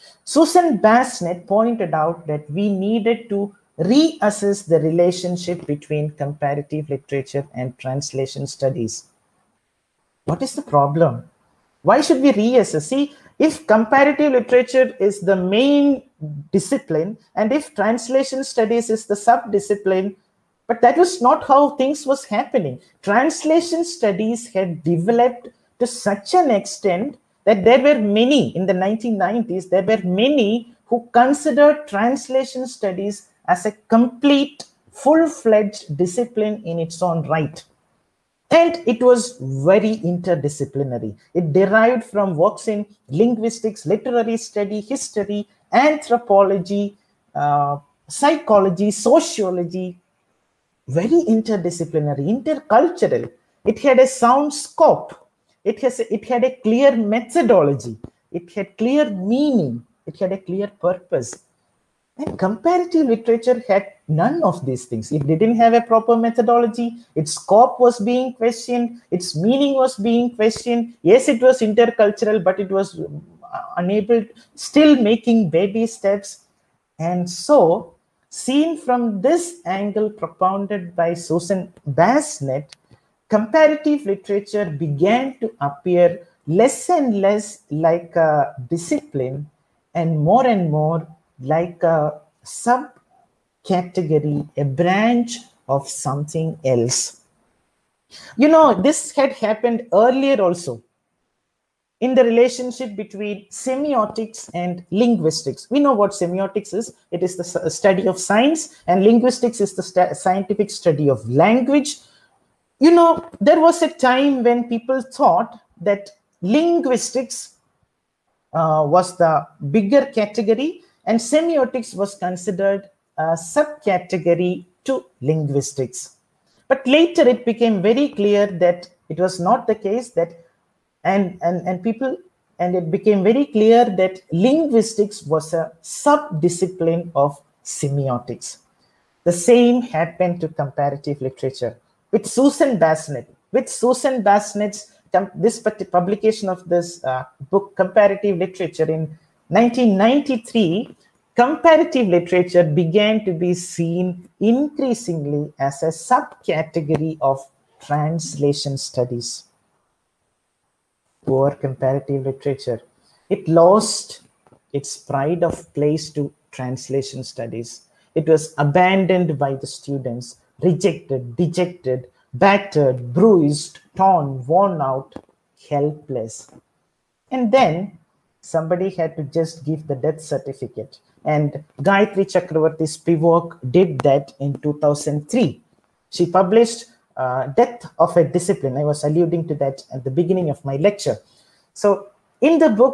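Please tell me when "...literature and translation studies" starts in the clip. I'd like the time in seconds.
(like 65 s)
6 s.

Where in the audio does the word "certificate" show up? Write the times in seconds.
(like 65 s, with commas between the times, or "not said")
180 s.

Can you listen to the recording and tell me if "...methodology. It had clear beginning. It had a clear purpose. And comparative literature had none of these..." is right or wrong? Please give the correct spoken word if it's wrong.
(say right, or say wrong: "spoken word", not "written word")
wrong: "meaning", not "beginning".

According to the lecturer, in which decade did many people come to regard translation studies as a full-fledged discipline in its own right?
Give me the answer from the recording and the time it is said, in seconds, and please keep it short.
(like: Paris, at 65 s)
1990s, at 28 s.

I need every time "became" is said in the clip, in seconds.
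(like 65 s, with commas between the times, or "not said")
127 s, 132 s.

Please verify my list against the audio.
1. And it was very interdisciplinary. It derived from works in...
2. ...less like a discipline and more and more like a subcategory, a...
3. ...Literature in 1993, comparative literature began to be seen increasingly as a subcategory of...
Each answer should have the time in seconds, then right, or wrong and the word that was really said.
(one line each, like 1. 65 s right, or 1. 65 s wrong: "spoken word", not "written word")
1. 38 s right
2. 87 s right
3. 148 s right.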